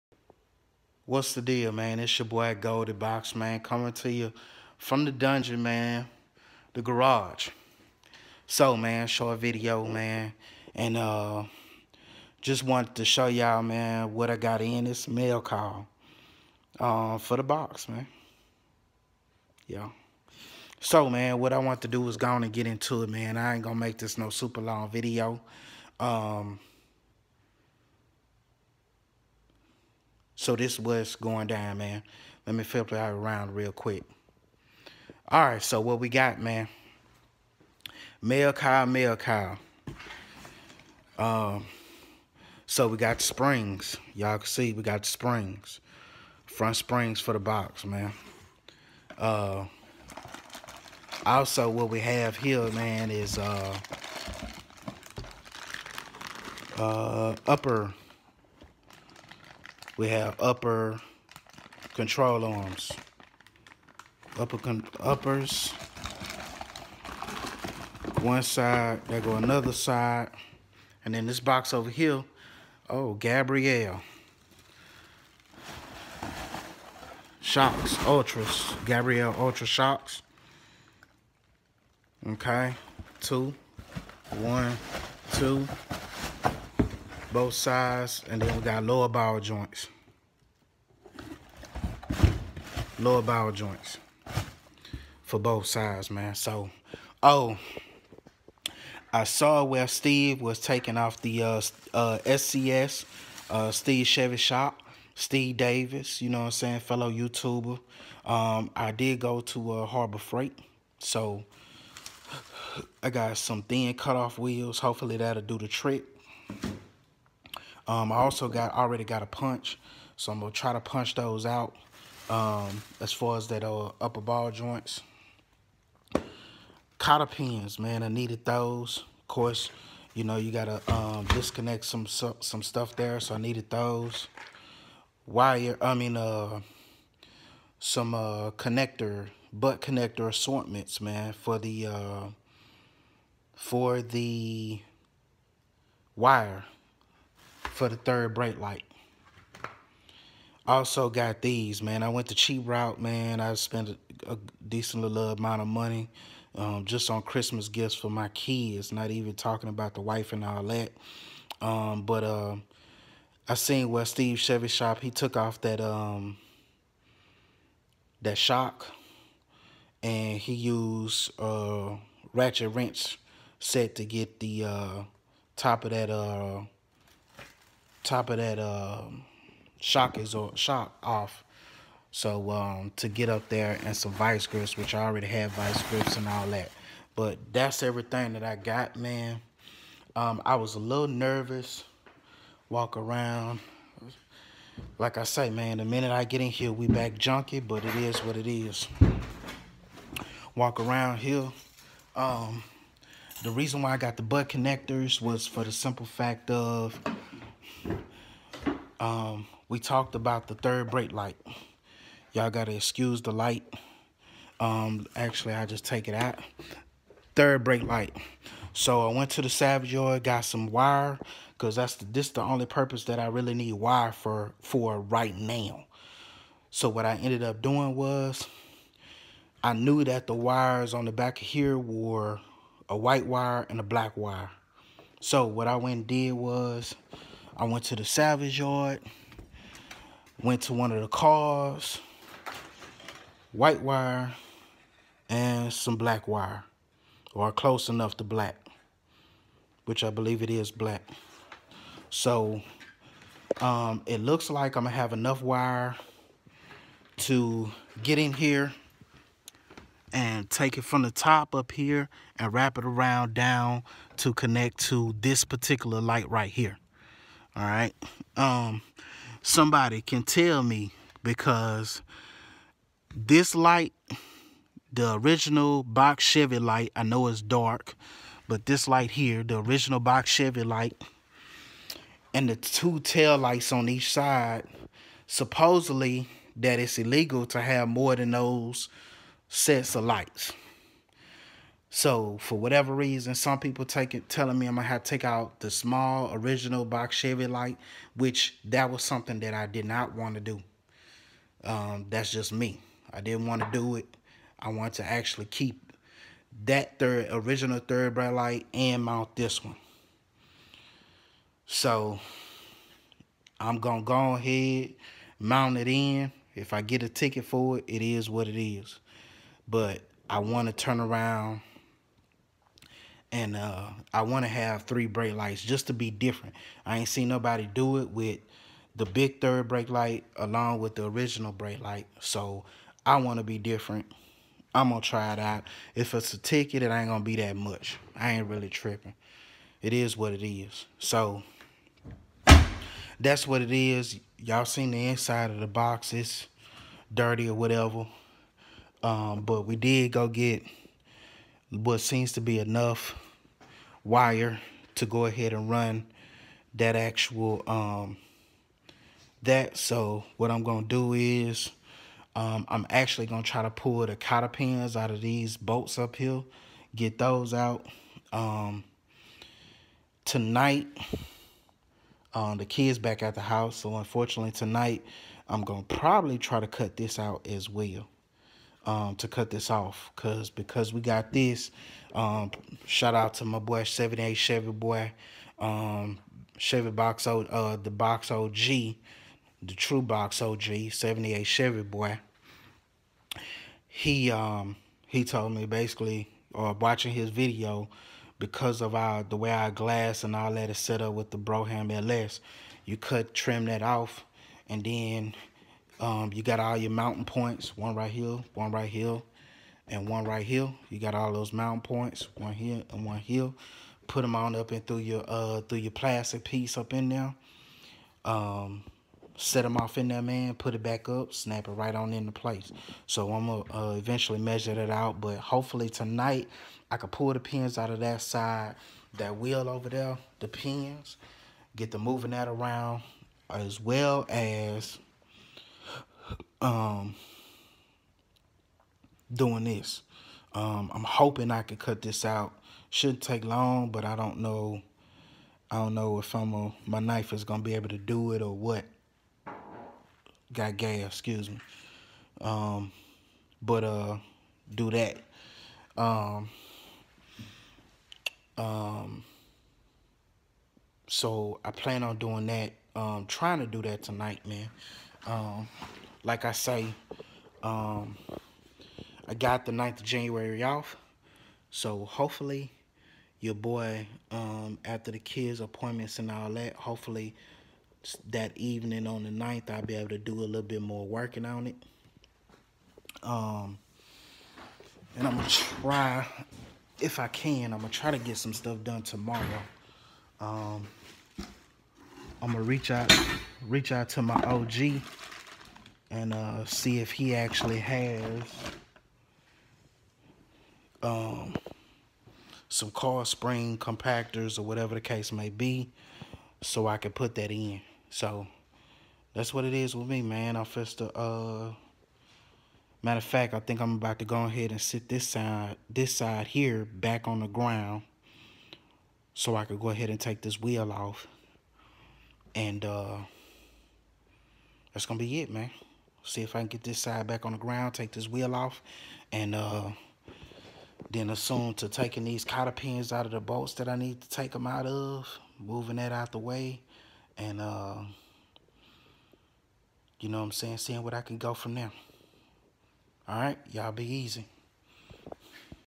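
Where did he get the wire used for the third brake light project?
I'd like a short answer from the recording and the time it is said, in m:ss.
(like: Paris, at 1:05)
Salvage yard, at 3:58.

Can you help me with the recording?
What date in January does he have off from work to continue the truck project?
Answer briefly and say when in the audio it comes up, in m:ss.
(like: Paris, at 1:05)
January 9, at 7:49.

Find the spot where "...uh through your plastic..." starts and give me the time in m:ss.
6:55.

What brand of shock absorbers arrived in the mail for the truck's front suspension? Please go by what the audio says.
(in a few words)
Gabriel Ultra.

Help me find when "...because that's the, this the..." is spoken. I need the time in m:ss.
3:41.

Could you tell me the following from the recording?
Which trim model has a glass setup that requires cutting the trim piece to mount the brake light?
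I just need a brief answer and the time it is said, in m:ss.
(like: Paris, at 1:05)
Brougham LS, at 6:41.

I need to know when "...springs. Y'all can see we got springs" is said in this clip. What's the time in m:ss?
0:43.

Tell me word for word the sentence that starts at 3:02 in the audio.
So um, to get up there and some vice grips, which I already have vice grips and all that.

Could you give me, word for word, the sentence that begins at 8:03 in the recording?
Um, and I'm going to try, if I can, I'm going to try to get some stuff done tomorrow.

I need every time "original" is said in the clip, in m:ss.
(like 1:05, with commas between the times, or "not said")
4:35, 4:39, 4:56, 5:07, 5:31.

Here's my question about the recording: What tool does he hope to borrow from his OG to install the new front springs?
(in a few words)
Spring compactors.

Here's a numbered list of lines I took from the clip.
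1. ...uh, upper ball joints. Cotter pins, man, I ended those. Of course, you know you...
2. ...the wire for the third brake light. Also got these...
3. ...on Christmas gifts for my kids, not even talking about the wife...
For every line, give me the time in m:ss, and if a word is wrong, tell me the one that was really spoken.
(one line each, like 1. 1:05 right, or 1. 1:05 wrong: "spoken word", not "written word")
1. 2:03 wrong: "needed", not "ended"
2. 2:24 right
3. 2:37 right.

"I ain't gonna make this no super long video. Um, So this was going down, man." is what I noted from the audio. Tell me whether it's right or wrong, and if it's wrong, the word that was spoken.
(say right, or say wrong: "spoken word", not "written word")
right.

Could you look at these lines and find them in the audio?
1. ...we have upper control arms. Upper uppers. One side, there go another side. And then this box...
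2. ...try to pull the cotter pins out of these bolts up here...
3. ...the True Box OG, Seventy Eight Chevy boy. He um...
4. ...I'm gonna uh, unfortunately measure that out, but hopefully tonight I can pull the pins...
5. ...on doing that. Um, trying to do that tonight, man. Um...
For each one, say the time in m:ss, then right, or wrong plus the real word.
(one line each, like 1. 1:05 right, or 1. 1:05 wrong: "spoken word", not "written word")
1. 1:00 right
2. 6:03 right
3. 6:28 right
4. 7:03 wrong: "eventually", not "unfortunately"
5. 7:42 right.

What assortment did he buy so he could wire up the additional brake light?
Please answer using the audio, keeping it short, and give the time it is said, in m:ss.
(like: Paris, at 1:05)
Butt connector assortments, at 2:19.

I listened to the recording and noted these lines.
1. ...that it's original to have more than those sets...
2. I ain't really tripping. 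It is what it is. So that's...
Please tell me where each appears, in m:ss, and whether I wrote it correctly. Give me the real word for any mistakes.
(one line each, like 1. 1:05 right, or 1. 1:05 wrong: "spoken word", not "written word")
1. 4:46 wrong: "illegal", not "original"
2. 5:38 right.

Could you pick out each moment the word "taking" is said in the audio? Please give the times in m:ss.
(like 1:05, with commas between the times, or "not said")
1:40, 8:51.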